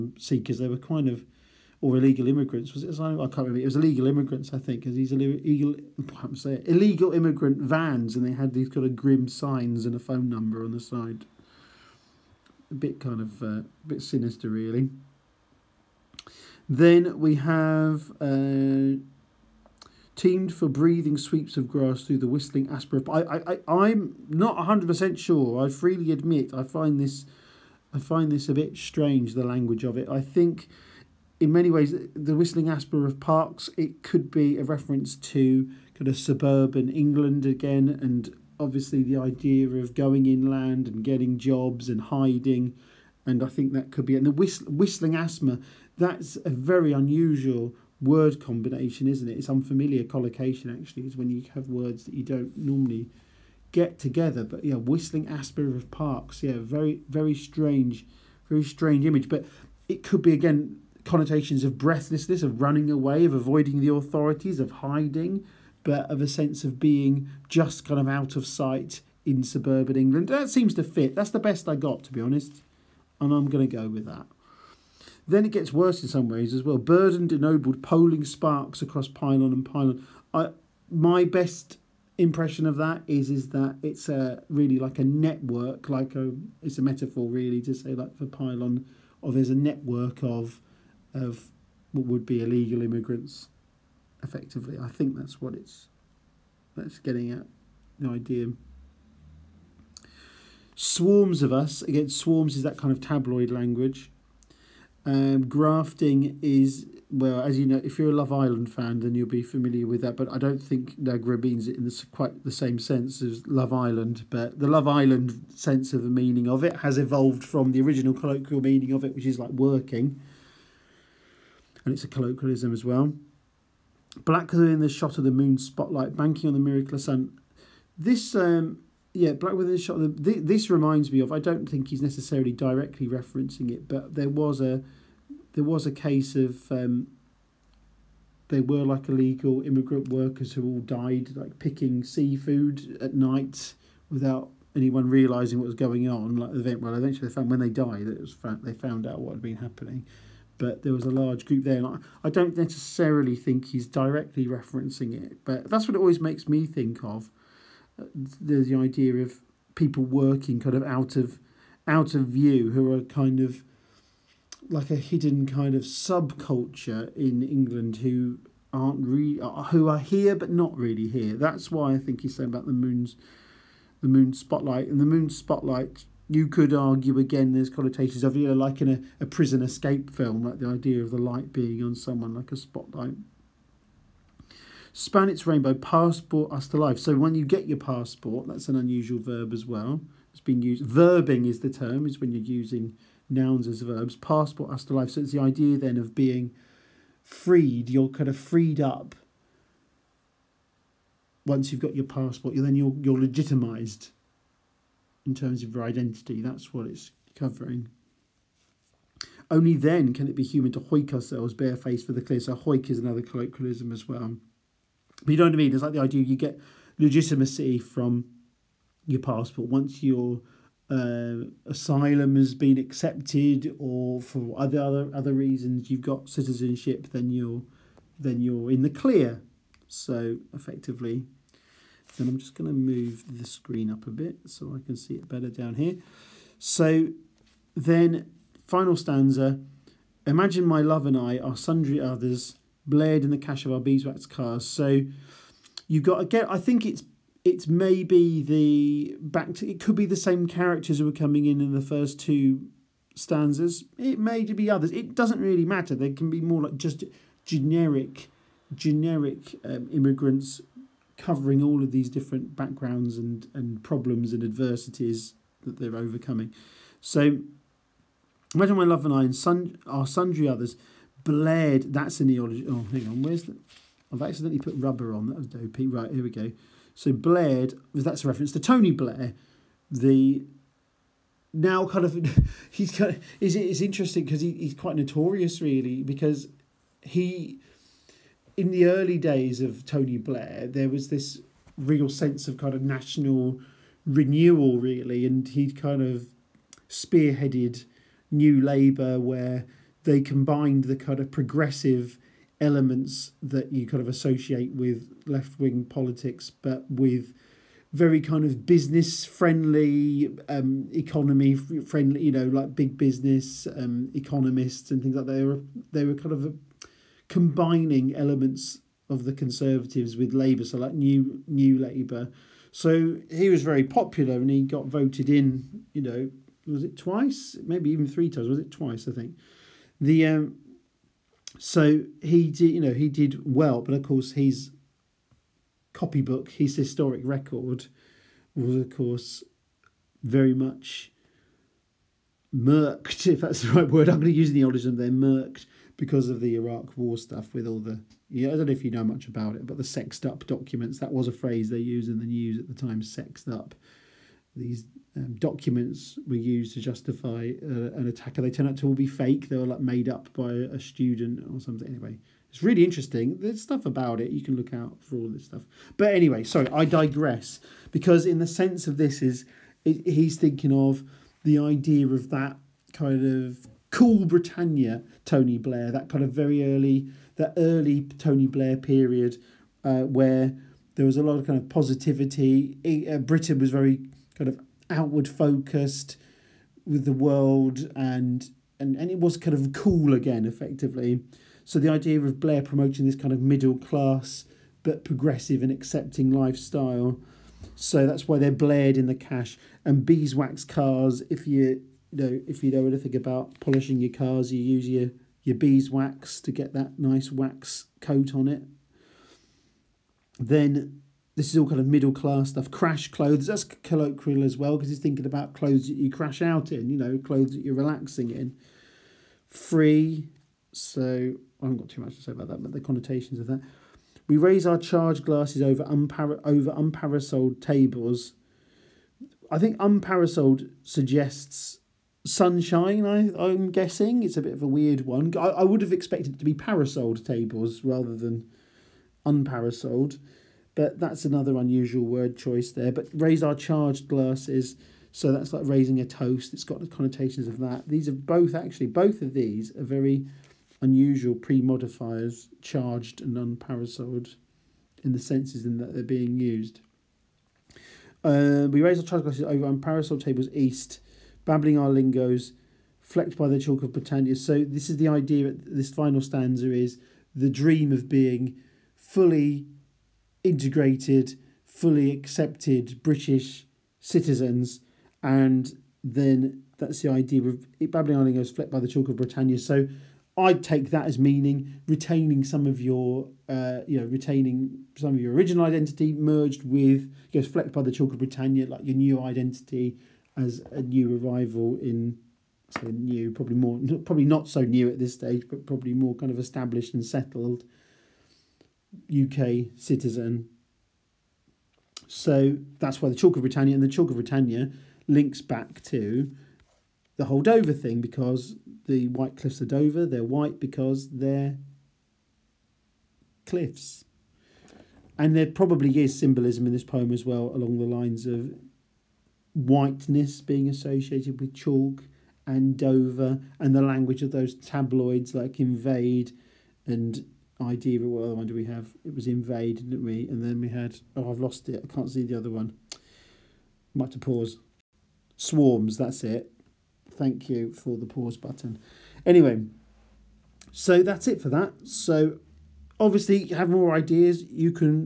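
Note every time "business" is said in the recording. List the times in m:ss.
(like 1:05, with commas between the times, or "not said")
5:08, 5:12.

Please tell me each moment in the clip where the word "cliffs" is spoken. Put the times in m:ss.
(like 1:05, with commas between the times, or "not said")
8:29, 8:33.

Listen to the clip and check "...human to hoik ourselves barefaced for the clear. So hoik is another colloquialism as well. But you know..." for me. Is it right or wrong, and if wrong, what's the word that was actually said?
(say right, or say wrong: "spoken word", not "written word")
right.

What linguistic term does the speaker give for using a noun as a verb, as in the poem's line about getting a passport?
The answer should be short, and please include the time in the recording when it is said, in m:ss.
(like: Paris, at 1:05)
verbing, at 3:10.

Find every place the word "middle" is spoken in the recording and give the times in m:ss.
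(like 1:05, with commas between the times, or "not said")
6:33, 6:51.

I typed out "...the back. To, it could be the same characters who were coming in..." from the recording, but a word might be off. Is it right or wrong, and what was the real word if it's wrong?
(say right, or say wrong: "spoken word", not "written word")
right.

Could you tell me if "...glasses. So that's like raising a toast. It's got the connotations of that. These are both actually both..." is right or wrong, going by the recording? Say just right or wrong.
right.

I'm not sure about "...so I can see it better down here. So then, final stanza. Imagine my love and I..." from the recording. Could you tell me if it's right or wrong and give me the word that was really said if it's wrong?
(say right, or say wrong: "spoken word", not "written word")
right.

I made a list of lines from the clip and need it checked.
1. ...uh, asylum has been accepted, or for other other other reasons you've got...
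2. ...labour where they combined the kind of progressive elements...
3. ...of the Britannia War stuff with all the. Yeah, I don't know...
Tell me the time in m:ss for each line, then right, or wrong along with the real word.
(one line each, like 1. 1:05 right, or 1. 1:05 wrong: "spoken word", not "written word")
1. 3:40 right
2. 4:58 right
3. 5:46 wrong: "Iraq", not "Britannia".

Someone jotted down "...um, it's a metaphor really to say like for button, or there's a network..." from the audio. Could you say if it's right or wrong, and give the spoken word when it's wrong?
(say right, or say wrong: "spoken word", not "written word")
wrong: "pylon", not "button".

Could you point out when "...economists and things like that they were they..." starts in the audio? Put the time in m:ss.
5:14.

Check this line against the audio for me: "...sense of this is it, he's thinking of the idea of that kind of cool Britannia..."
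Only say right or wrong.
right.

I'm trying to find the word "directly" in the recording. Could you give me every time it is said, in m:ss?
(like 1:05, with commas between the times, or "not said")
2:12, 2:33.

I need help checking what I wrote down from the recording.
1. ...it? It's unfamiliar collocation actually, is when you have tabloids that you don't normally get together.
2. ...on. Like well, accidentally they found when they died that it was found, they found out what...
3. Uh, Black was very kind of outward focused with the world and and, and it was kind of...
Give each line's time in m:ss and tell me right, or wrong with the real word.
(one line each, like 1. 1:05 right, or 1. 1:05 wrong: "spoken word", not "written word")
1. 0:49 wrong: "words", not "tabloids"
2. 2:26 wrong: "eventually", not "accidentally"
3. 6:23 wrong: "Britain", not "Black".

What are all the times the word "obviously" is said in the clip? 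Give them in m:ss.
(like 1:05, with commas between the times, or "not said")
0:38, 9:02.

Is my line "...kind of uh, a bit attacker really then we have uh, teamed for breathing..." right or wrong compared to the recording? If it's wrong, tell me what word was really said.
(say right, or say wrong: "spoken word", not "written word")
wrong: "sinister", not "attacker".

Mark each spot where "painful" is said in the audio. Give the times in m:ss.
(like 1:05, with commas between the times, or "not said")
not said.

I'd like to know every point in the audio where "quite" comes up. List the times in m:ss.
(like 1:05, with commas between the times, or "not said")
1:52, 4:44.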